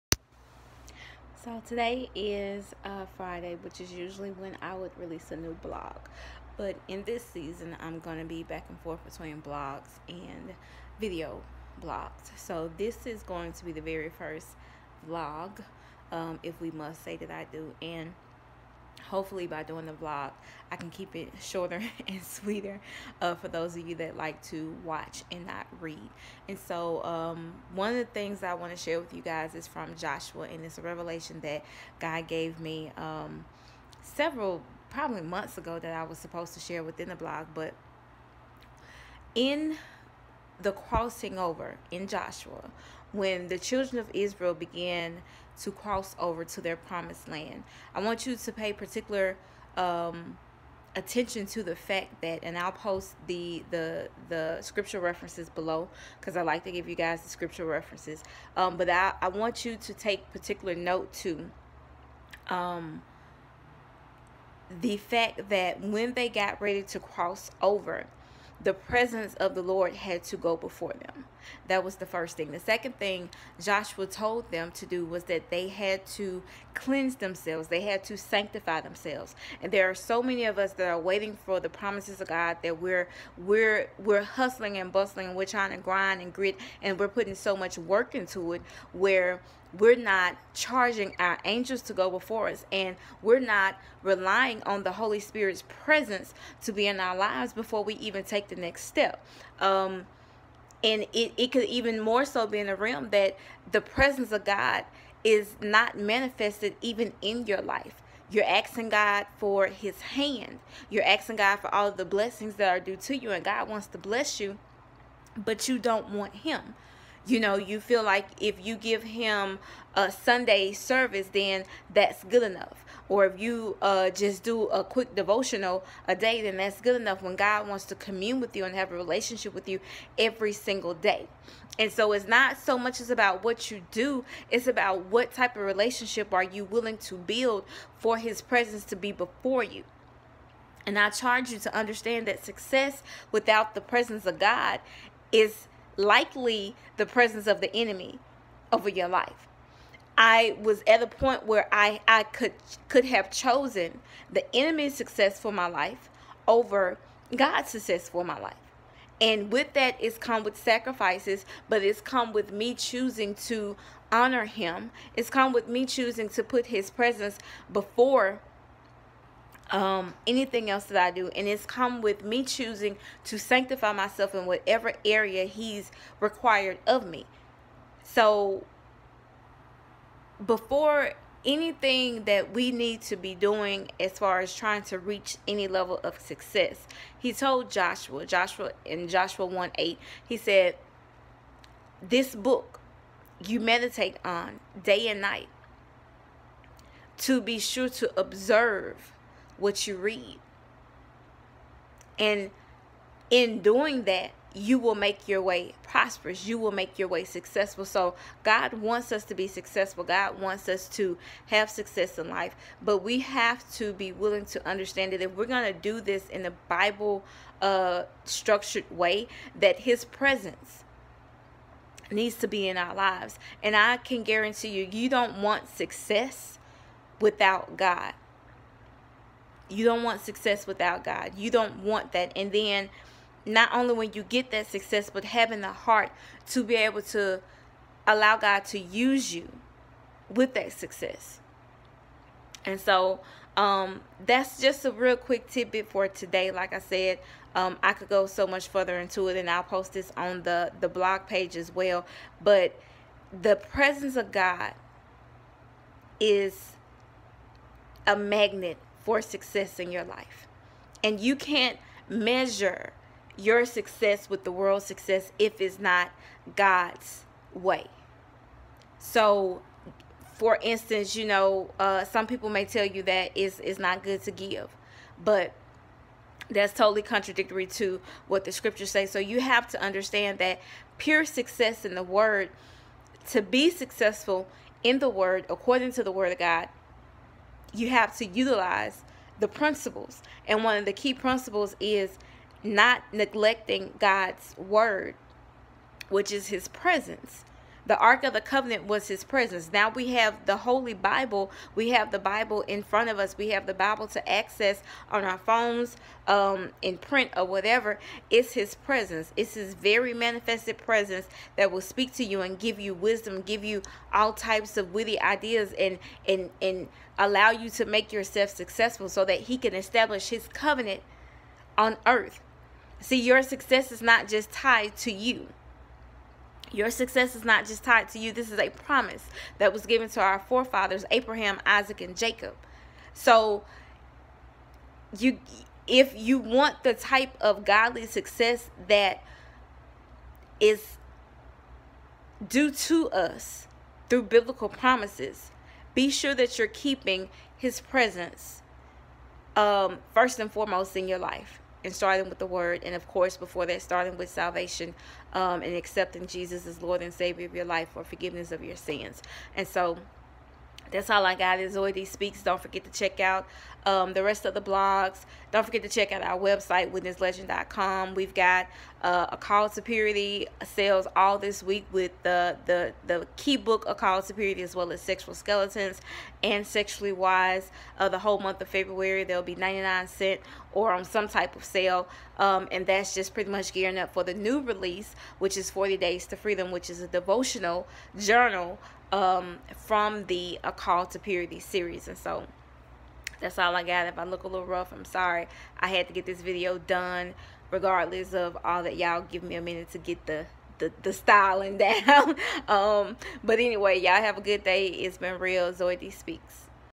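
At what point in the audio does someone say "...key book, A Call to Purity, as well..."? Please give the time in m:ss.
6:13.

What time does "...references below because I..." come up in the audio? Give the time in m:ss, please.
0:54.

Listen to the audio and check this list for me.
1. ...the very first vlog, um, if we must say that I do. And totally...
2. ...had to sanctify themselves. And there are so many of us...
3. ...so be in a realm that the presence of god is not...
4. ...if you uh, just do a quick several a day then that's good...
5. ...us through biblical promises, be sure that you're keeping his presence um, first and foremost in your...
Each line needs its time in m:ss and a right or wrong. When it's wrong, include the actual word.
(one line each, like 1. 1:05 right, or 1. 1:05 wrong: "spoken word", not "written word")
1. 0:13 wrong: "hopefully", not "totally"
2. 1:17 right
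3. 1:42 right
4. 2:03 wrong: "devotional", not "several"
5. 5:43 right.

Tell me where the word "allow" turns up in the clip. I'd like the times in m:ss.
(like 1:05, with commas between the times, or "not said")
3:58, 5:17.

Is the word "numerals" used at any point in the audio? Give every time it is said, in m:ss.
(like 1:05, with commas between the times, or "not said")
not said.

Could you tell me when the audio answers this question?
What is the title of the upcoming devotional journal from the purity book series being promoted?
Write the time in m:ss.
6:25.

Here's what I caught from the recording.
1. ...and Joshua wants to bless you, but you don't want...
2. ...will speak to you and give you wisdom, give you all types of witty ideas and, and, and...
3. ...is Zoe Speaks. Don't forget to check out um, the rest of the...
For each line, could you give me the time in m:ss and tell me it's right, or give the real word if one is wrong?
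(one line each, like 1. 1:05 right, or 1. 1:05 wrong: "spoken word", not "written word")
1. 1:53 wrong: "God", not "Joshua"
2. 5:11 right
3. 6:01 right.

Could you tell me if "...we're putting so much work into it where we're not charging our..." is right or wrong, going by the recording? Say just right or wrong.
right.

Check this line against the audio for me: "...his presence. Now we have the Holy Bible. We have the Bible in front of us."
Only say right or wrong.
right.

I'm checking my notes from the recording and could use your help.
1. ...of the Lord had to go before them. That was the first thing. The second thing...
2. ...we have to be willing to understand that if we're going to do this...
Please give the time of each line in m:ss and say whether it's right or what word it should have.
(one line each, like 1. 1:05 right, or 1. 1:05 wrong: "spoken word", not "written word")
1. 1:09 right
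2. 3:32 right.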